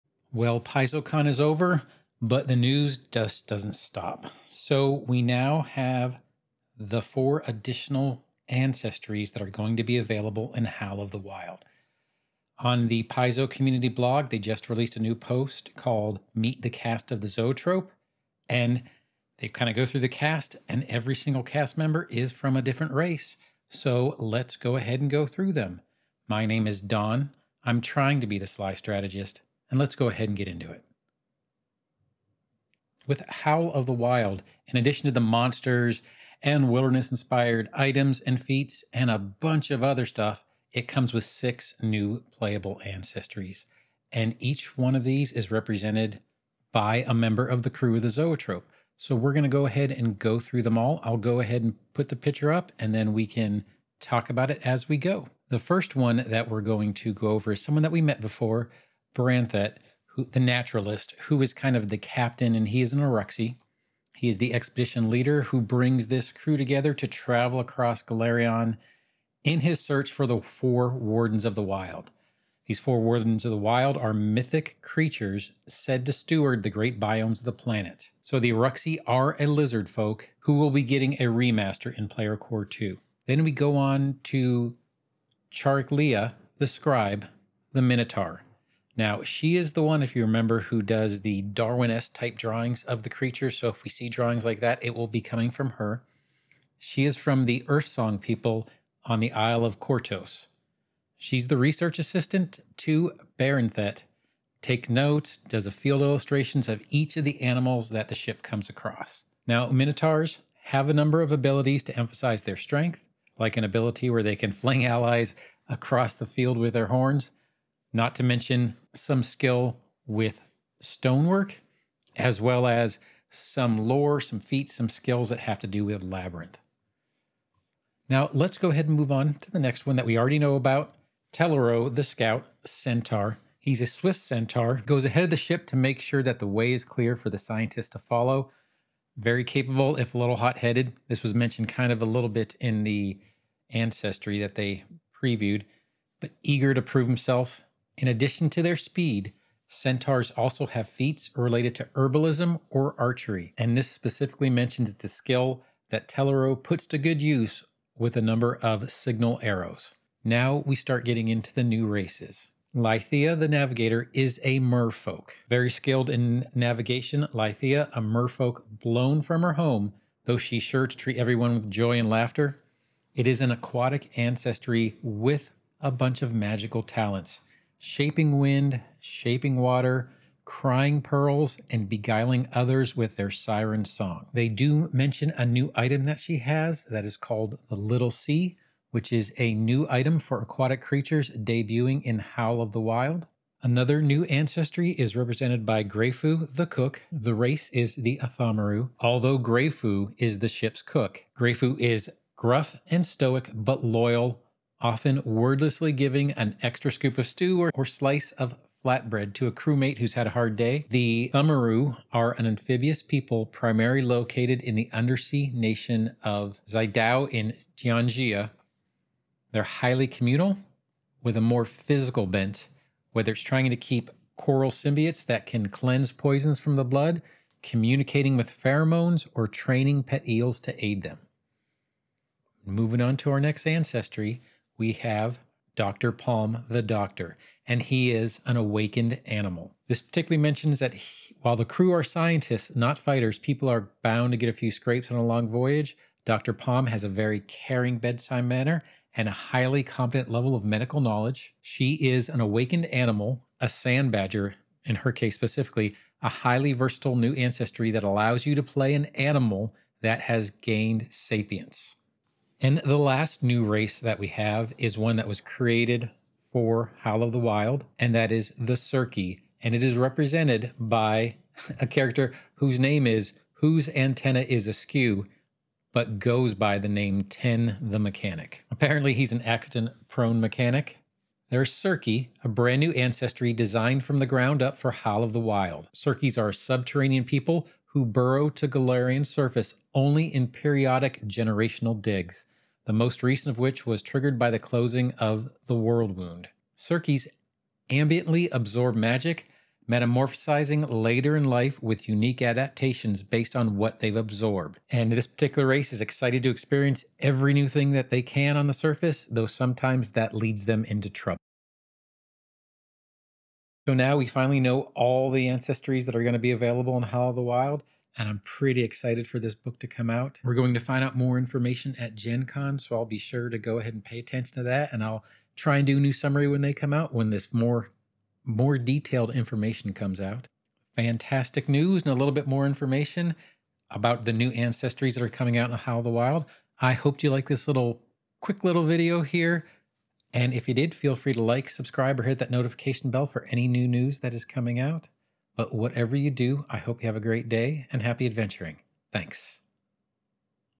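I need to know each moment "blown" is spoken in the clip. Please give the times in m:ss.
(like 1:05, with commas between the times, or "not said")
2:48.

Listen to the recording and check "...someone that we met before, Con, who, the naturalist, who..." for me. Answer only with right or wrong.
wrong.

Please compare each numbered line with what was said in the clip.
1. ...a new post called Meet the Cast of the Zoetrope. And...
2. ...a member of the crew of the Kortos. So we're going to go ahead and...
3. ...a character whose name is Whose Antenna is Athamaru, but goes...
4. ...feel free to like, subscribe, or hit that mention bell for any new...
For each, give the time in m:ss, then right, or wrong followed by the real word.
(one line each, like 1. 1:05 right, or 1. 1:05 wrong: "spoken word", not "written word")
1. 0:14 right
2. 0:47 wrong: "Zoetrope", not "Kortos"
3. 4:31 wrong: "Askew", not "Athamaru"
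4. 5:40 wrong: "notification", not "mention".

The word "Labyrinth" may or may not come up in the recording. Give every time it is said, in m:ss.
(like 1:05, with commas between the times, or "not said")
2:06.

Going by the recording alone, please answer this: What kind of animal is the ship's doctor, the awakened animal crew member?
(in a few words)
sand badger.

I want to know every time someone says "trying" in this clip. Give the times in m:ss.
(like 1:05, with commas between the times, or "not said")
0:27, 3:43.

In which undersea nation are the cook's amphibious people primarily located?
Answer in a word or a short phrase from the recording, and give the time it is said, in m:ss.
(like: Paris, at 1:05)
Zaidao, at 3:36.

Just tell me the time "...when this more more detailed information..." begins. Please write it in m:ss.
5:27.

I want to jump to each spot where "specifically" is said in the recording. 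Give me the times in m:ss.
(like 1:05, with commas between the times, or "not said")
2:33, 4:15.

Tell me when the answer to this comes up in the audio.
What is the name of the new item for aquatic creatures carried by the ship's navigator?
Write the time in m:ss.
3:07.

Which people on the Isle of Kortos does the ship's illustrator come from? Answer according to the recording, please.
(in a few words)
Earth Song.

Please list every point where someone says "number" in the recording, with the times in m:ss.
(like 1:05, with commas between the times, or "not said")
1:50, 2:38.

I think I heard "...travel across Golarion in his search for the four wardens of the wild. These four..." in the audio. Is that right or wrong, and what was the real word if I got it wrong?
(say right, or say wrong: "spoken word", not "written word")
right.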